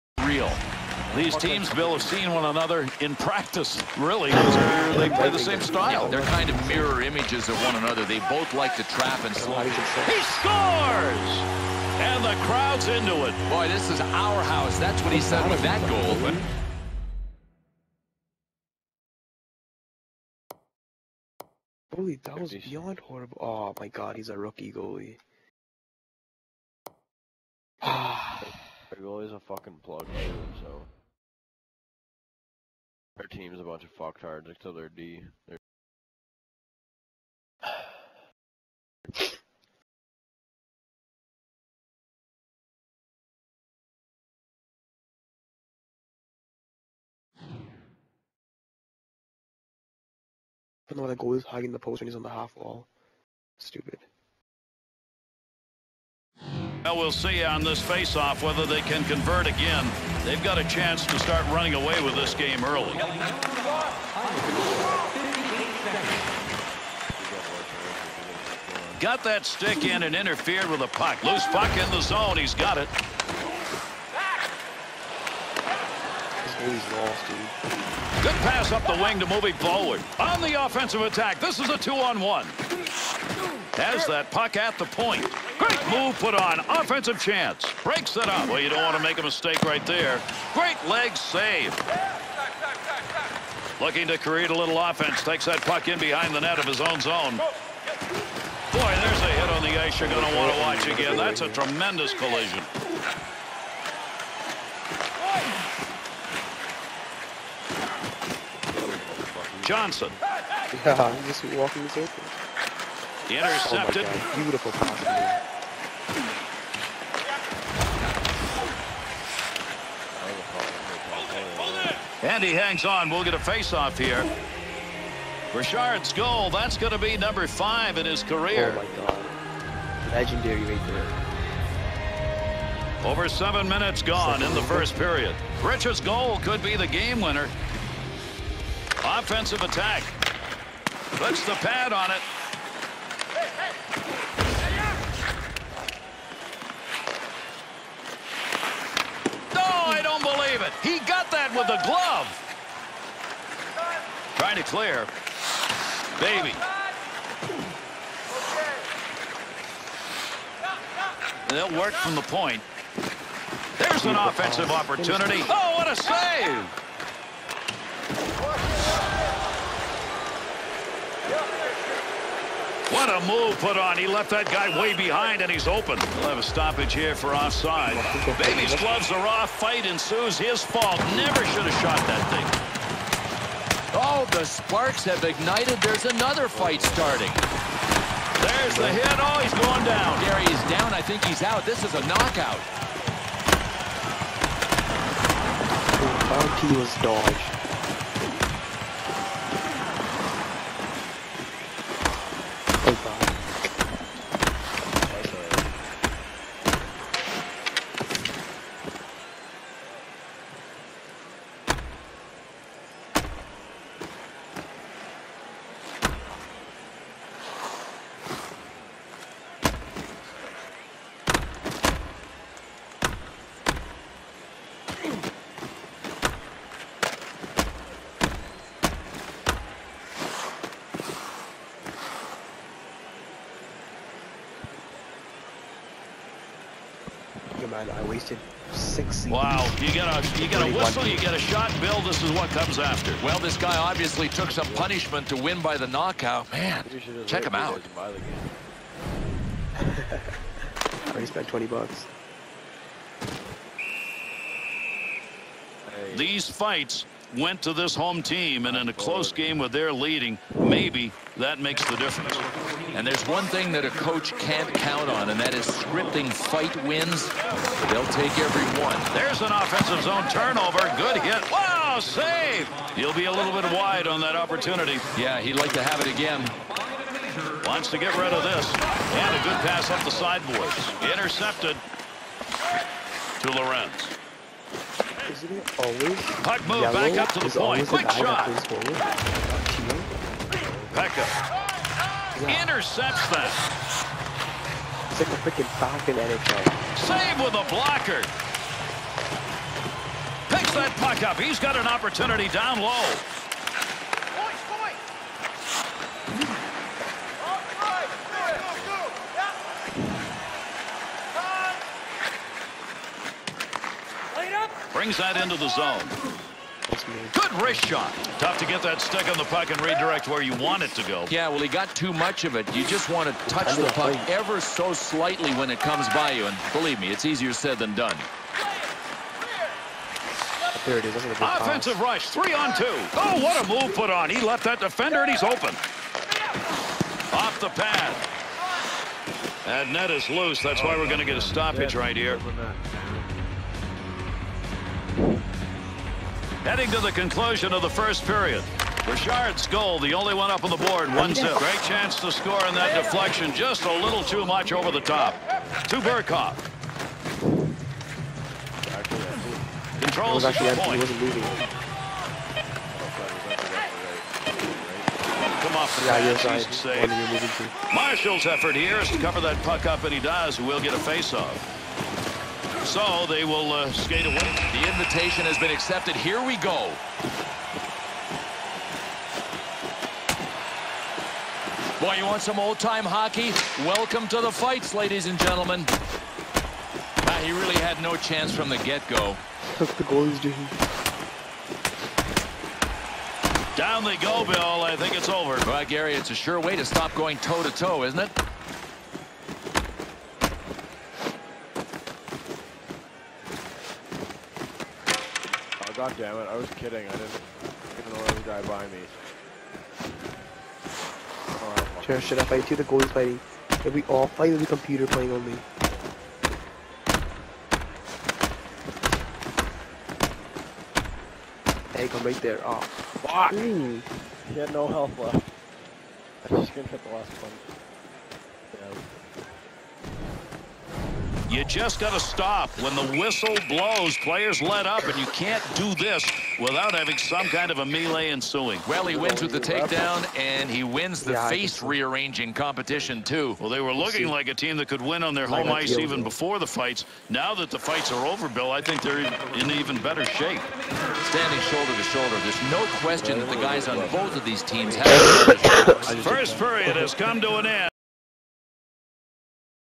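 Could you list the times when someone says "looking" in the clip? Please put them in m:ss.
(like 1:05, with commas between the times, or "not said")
1:33, 7:23.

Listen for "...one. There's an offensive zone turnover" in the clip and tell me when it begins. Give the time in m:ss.
4:28.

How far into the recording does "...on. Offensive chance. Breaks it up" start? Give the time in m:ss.
1:26.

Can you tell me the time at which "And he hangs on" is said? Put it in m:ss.
2:02.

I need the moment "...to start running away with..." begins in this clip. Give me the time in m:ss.
1:01.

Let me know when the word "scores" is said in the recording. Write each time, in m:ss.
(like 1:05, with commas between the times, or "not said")
0:10, 5:52.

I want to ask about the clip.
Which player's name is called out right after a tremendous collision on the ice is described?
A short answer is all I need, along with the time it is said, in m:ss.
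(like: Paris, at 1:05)
Johnson, at 1:49.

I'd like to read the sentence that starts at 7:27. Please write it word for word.
Now that the fights are over, Bill, I think they're in even better shape.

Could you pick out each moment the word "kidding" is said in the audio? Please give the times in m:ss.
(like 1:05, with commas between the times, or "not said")
6:46.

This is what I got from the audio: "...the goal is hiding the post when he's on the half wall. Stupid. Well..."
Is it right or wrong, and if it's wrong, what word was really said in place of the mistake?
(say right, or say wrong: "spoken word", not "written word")
right.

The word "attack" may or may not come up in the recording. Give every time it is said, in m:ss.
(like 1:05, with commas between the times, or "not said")
1:21, 2:19.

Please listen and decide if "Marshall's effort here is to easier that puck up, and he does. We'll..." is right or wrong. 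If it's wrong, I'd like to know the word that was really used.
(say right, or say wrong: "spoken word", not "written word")
wrong: "cover", not "easier".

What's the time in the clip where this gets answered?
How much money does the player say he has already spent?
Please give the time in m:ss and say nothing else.
4:11.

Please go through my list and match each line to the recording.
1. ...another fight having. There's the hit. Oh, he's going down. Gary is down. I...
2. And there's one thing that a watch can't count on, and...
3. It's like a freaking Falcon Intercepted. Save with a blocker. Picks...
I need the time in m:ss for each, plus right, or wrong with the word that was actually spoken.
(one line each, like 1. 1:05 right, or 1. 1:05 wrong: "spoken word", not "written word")
1. 3:06 wrong: "starting", not "having"
2. 4:22 wrong: "coach", not "watch"
3. 4:55 wrong: "NHL", not "Intercepted".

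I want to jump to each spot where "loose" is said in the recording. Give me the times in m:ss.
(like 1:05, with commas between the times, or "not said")
1:11, 5:40.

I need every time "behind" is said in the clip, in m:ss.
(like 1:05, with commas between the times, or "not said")
1:35, 2:54.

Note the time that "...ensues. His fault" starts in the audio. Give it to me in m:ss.
2:59.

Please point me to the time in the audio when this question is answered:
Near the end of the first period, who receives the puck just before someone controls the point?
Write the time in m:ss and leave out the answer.
5:55.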